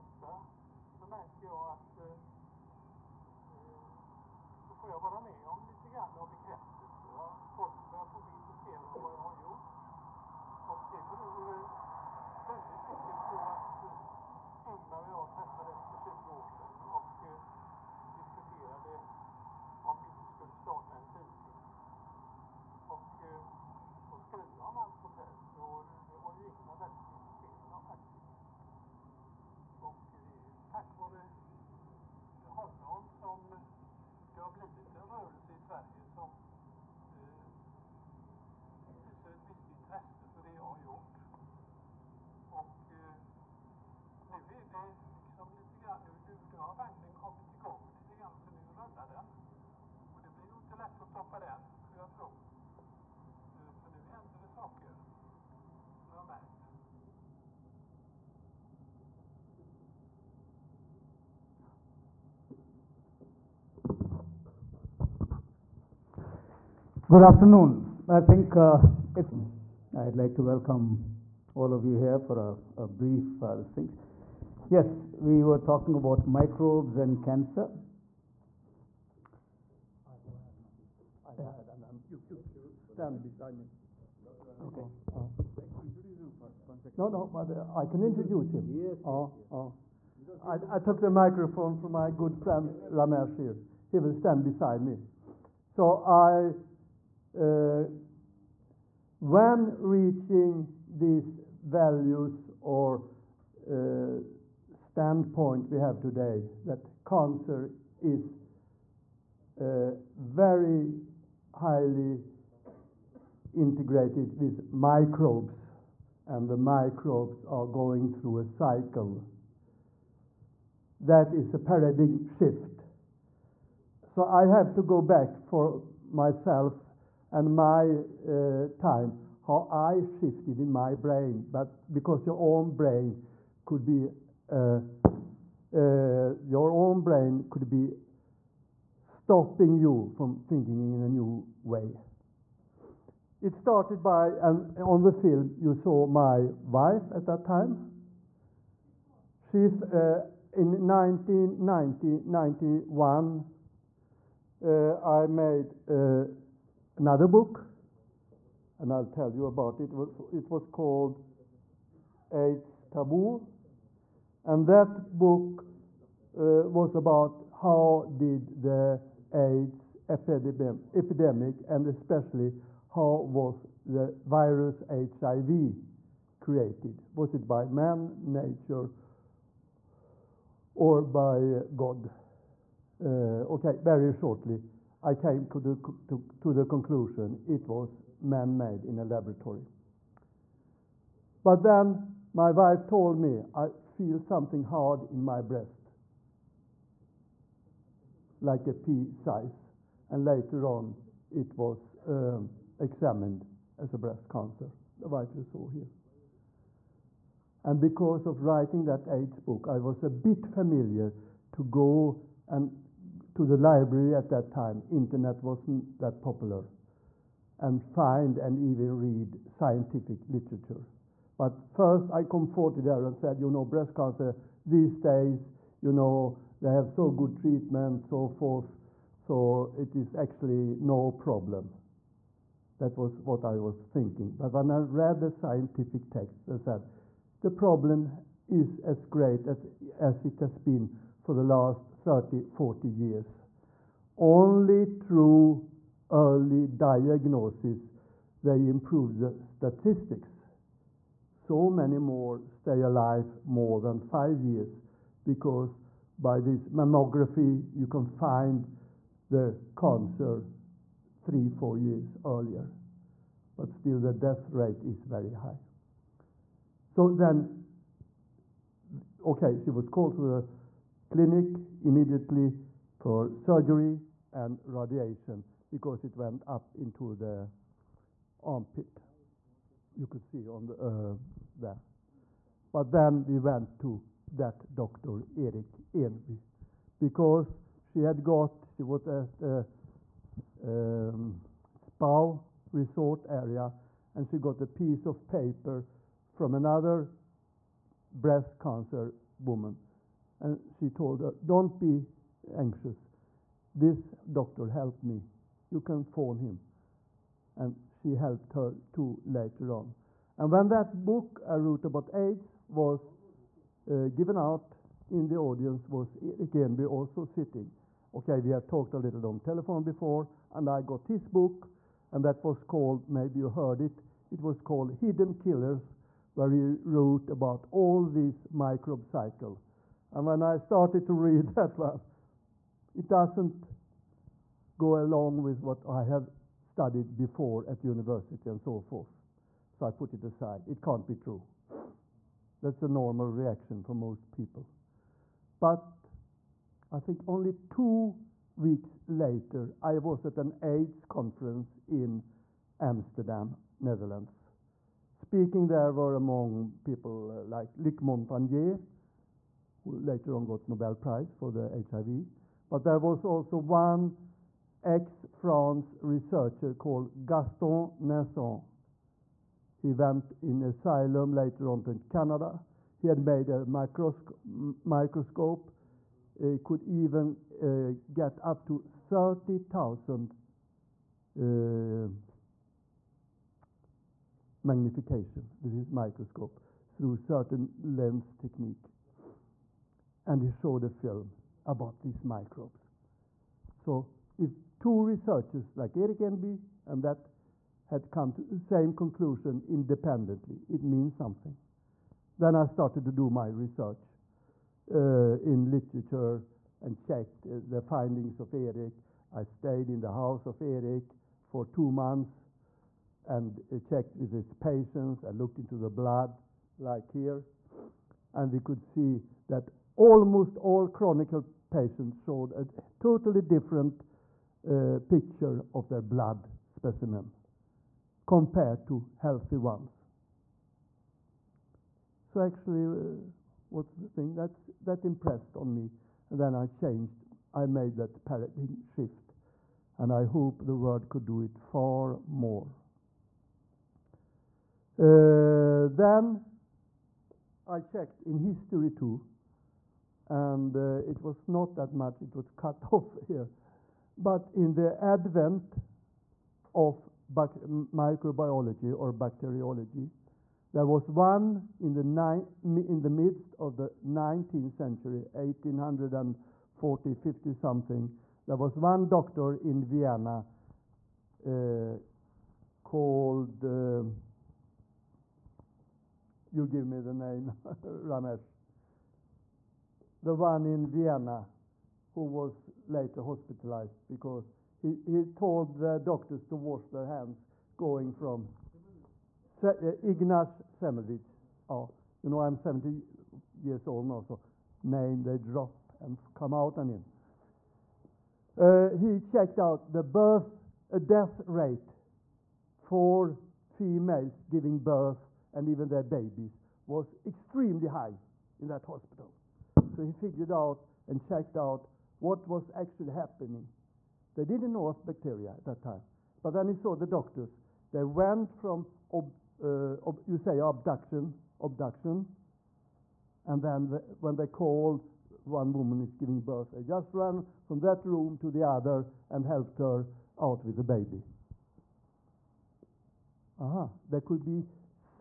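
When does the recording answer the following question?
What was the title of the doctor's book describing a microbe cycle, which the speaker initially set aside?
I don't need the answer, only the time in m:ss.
5:24.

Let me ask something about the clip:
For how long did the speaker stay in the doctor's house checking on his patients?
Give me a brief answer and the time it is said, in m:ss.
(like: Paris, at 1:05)
two months, at 6:51.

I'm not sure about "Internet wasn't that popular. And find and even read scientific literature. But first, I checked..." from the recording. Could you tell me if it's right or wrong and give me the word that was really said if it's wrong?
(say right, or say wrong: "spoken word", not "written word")
wrong: "comforted", not "checked".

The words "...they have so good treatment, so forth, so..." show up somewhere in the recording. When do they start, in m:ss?
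3:46.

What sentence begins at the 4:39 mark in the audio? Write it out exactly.
You could see on the, uh, there.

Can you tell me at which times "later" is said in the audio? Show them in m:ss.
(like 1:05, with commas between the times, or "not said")
3:20, 5:09, 5:49, 6:00, 6:11, 8:02.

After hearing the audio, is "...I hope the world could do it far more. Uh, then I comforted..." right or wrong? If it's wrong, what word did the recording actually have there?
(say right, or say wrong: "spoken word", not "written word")
wrong: "checked", not "comforted".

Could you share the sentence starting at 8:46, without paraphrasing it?
They just ran from that room to the other and helped her out with the baby.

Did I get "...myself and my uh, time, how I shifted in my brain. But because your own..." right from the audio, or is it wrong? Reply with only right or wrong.
right.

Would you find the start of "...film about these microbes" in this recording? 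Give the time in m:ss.
6:30.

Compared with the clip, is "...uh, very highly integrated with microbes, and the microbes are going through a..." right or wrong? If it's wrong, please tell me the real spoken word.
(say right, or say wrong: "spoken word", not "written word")
right.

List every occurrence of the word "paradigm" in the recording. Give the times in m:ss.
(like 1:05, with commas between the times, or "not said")
2:01, 7:18.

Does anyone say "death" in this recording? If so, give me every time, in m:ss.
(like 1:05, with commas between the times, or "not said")
4:24, 8:20.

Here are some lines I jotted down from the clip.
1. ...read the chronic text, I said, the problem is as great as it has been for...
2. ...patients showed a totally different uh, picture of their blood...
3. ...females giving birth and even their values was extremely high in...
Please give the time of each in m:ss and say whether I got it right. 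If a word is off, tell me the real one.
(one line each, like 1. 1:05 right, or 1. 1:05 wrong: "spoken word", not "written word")
1. 3:54 wrong: "scientific", not "chronic"
2. 7:01 right
3. 8:23 wrong: "babies", not "values".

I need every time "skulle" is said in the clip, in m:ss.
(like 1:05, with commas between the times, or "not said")
0:51.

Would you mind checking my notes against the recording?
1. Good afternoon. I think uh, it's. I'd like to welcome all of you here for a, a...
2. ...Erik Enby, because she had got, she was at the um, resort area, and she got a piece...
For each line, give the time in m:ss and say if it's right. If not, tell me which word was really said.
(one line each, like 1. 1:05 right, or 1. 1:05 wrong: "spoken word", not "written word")
1. 1:07 right
2. 4:45 right.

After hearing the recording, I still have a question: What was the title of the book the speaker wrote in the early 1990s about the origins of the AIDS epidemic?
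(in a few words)
AIDS Taboo.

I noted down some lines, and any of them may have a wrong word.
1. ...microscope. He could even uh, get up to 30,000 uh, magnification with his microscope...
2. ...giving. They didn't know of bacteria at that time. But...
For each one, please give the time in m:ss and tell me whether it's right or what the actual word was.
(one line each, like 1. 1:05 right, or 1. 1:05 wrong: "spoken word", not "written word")
1. 6:14 right
2. 8:33 wrong: "happening", not "giving".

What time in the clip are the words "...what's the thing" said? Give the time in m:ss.
7:13.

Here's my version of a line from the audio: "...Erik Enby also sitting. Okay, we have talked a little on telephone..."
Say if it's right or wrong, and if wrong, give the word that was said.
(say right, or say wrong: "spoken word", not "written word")
right.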